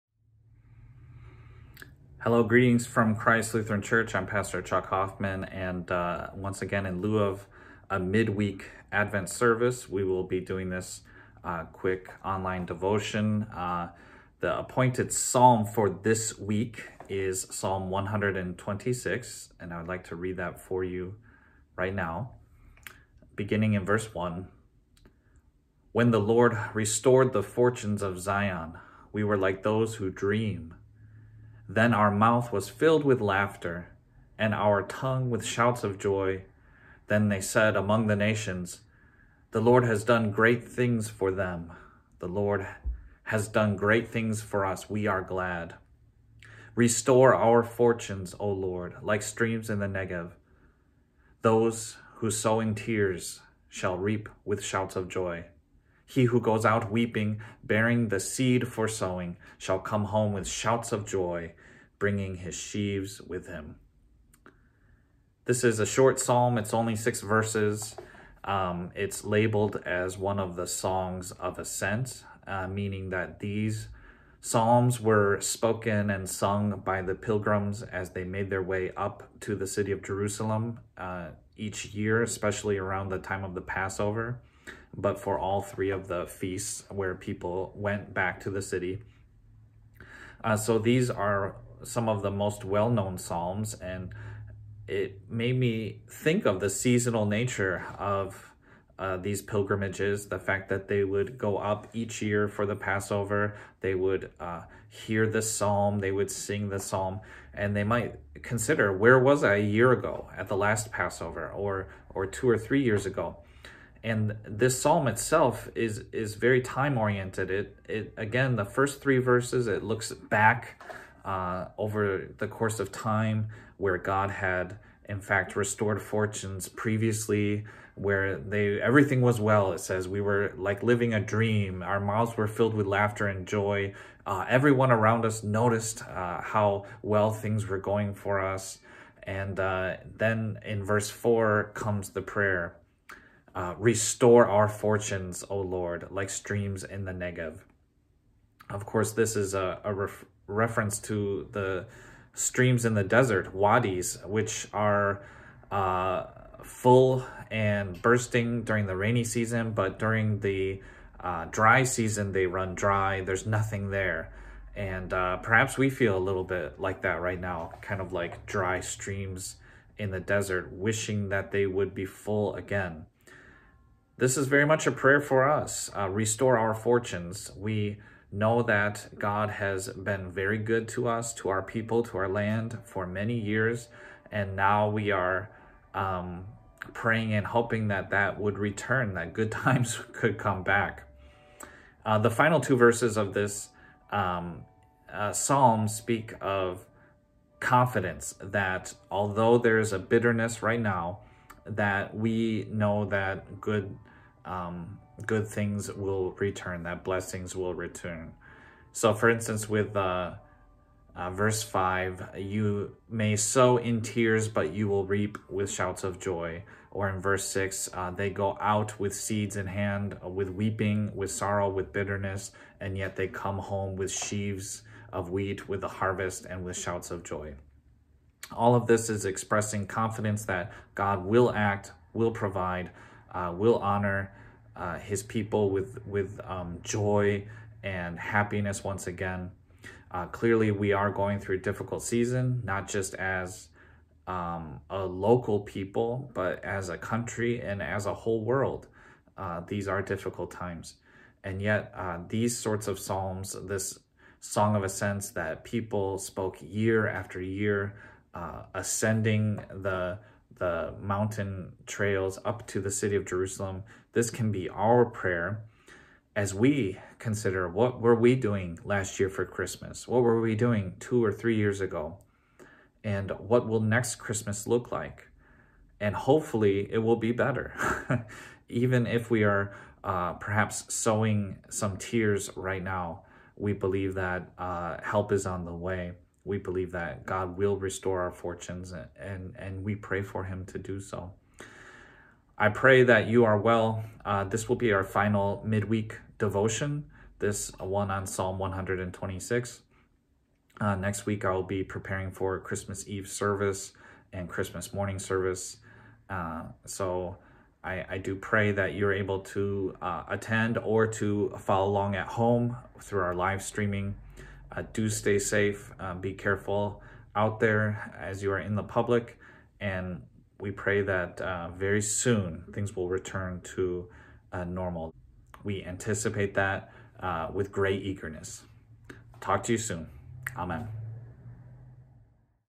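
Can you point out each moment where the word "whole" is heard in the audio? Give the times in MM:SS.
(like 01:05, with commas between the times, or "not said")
04:08.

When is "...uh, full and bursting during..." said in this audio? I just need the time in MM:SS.
02:35.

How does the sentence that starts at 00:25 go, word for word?
When the Lord restored the fortunes of Zion, we were like those who dream.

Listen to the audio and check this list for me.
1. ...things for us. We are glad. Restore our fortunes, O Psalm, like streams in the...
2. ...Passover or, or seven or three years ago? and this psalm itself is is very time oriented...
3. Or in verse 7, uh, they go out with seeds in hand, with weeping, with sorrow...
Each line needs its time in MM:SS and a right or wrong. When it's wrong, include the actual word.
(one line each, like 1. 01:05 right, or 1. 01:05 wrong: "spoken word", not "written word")
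1. 00:44 wrong: "Lord", not "Psalm"
2. 01:50 wrong: "two", not "seven"
3. 03:36 wrong: "6", not "7".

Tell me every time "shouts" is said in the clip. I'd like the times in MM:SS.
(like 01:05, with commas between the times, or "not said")
00:35, 00:54, 01:00, 03:35, 03:46.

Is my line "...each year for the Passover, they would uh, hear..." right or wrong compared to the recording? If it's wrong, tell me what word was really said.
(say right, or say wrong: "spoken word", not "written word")
right.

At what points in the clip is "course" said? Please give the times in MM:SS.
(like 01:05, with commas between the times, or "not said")
02:02, 02:28.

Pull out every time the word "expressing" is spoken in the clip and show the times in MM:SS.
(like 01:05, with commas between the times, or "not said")
03:49.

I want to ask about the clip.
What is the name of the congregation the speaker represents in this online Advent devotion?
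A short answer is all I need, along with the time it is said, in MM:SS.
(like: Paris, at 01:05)
Christ Lutheran Church, at 00:03.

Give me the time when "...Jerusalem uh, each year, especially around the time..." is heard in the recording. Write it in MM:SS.
01:20.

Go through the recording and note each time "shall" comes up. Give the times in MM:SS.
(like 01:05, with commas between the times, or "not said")
00:53, 00:59.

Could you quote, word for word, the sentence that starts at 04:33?
And what will next Christmas look like?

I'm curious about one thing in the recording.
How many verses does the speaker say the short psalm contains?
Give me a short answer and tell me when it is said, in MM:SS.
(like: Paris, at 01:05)
6, at 01:06.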